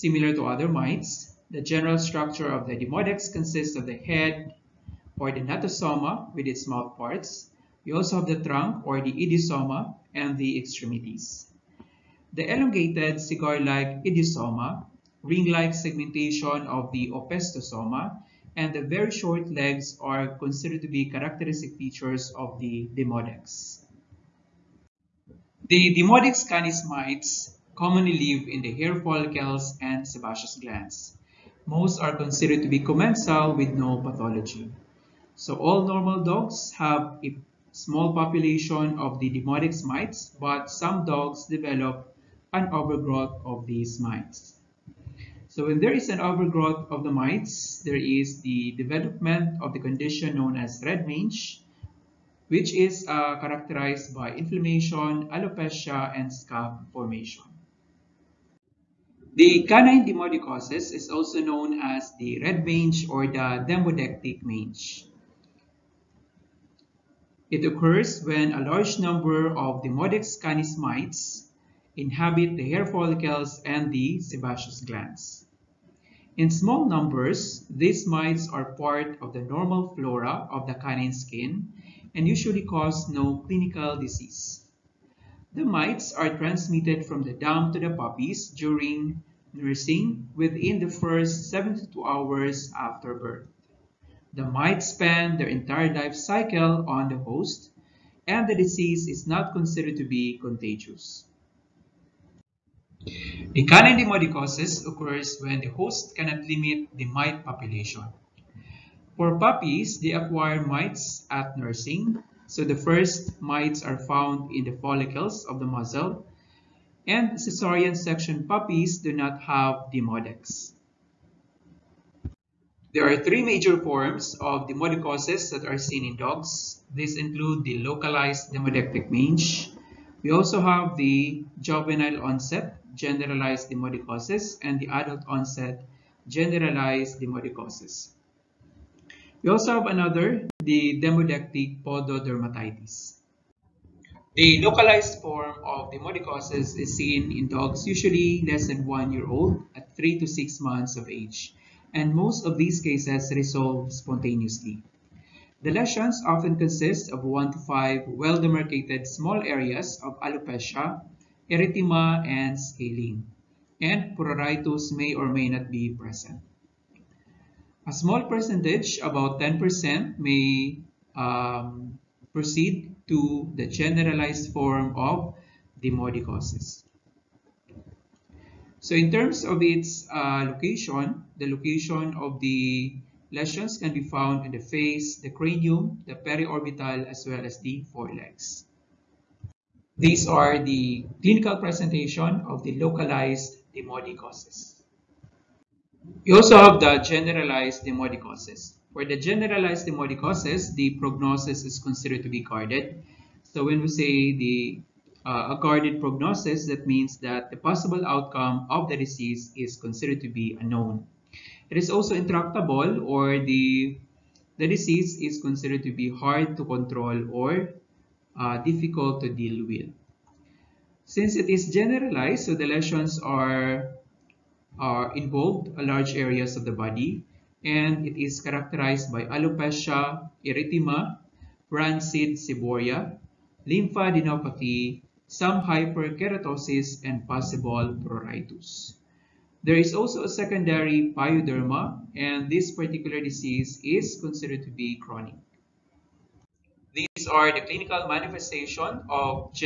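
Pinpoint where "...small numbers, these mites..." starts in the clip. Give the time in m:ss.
1:16.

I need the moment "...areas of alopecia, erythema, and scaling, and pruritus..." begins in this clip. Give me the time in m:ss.
2:39.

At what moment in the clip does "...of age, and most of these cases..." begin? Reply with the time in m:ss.
2:30.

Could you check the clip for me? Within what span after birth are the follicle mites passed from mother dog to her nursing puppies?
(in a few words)
72 hours.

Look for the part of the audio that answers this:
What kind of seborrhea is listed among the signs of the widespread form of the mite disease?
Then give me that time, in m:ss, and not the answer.
3:51.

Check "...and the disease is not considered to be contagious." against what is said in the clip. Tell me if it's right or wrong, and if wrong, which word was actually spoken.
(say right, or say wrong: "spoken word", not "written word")
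right.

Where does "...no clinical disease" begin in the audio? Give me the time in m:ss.
1:23.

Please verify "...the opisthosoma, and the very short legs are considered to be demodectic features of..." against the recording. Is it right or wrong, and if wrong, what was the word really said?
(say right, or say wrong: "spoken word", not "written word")
wrong: "characteristic", not "demodectic".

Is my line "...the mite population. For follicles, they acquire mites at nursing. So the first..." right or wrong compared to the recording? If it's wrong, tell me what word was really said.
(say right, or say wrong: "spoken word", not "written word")
wrong: "puppies", not "follicles".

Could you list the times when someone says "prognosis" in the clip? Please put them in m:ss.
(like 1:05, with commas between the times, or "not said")
3:20, 3:25.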